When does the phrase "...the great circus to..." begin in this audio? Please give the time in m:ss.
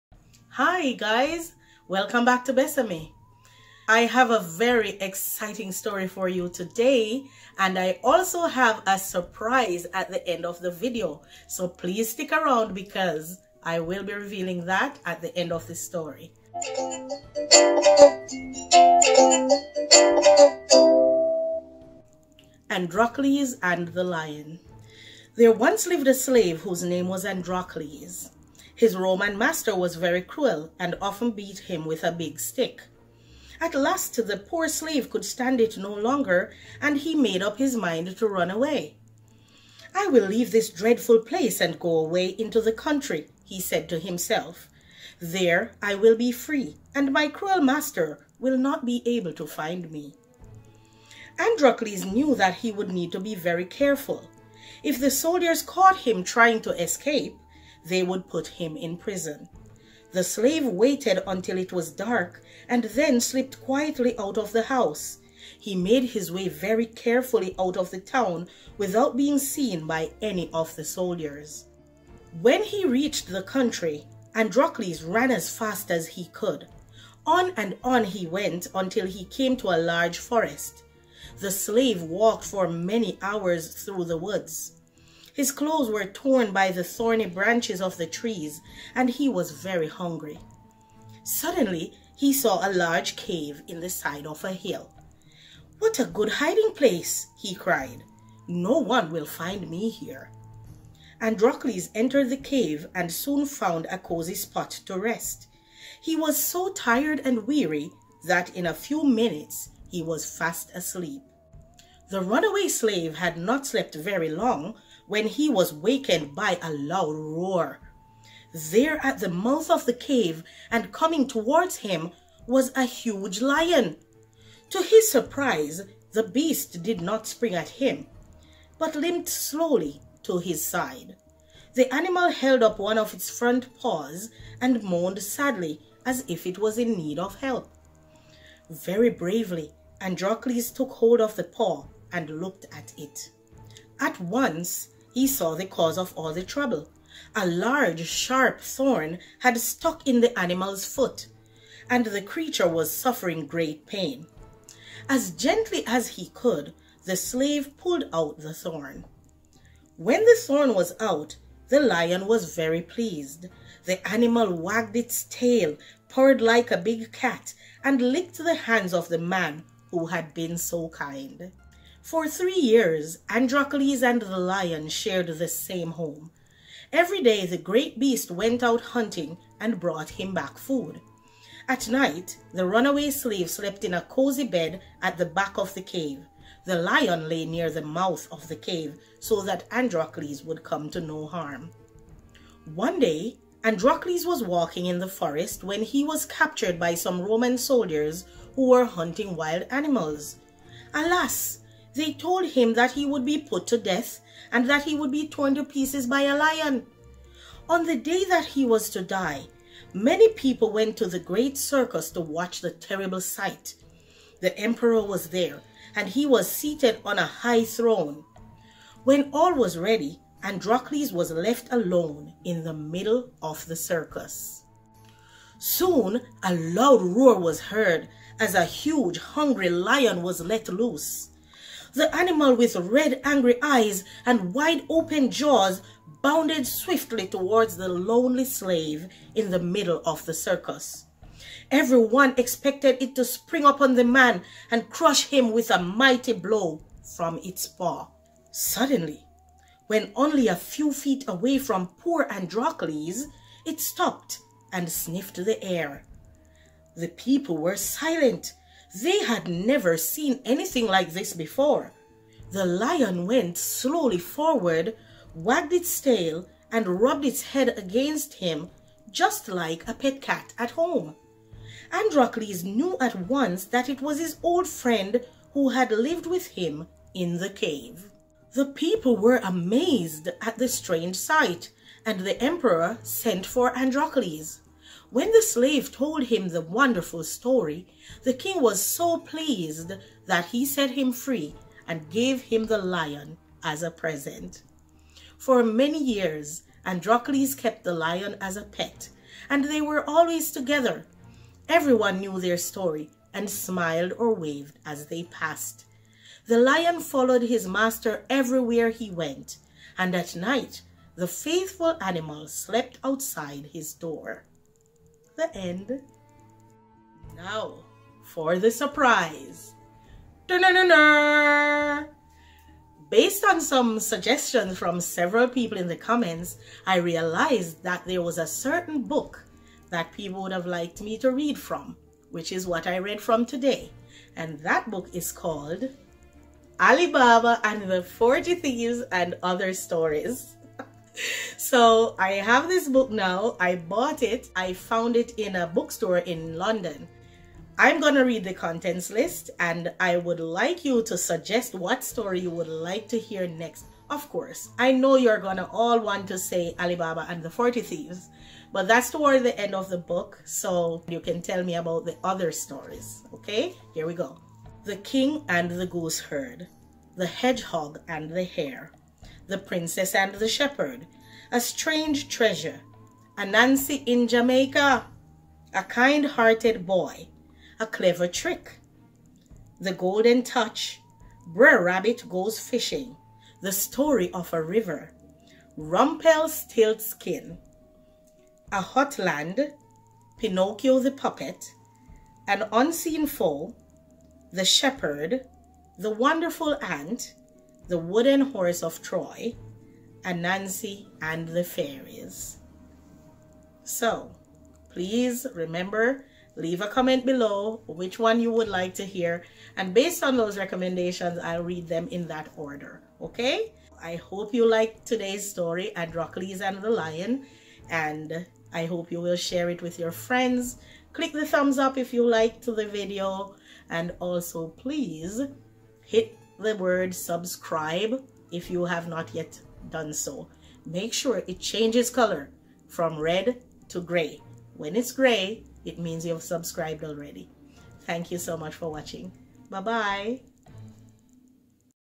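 3:31.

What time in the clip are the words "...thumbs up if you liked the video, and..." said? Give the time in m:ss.
7:01.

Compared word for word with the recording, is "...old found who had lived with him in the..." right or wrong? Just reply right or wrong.
wrong.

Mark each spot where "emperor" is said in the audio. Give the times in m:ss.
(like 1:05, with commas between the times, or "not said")
3:34, 4:42.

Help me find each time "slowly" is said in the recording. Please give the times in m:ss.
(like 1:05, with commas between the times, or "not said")
2:09, 4:23.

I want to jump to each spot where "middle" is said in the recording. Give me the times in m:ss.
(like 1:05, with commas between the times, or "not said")
3:42, 3:59.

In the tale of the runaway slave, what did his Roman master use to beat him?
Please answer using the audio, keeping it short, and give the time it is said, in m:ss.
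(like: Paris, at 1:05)
A big stick, at 0:32.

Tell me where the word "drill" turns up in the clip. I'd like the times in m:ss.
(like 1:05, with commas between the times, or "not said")
not said.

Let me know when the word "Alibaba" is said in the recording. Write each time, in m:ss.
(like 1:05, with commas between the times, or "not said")
5:36, 5:56.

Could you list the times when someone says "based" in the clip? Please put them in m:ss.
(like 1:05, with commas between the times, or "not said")
5:23, 6:49.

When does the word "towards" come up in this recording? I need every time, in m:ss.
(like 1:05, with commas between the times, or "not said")
2:01, 3:57, 5:59.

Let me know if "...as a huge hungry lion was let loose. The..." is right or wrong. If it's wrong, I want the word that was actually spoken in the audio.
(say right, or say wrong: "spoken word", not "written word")
right.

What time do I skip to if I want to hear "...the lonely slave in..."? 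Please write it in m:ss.
3:57.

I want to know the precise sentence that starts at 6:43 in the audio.
So, please remember, leave a comment below which one you would like to hear.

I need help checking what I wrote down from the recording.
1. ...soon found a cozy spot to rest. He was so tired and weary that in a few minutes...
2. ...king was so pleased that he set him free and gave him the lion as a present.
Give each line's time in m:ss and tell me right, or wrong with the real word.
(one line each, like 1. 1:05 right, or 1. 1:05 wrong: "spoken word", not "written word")
1. 1:43 right
2. 4:48 right.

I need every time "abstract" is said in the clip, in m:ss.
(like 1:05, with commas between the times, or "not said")
not said.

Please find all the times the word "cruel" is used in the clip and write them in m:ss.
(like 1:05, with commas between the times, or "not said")
0:30, 0:47.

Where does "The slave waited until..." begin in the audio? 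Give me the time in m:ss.
1:00.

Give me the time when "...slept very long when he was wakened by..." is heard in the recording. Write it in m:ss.
1:53.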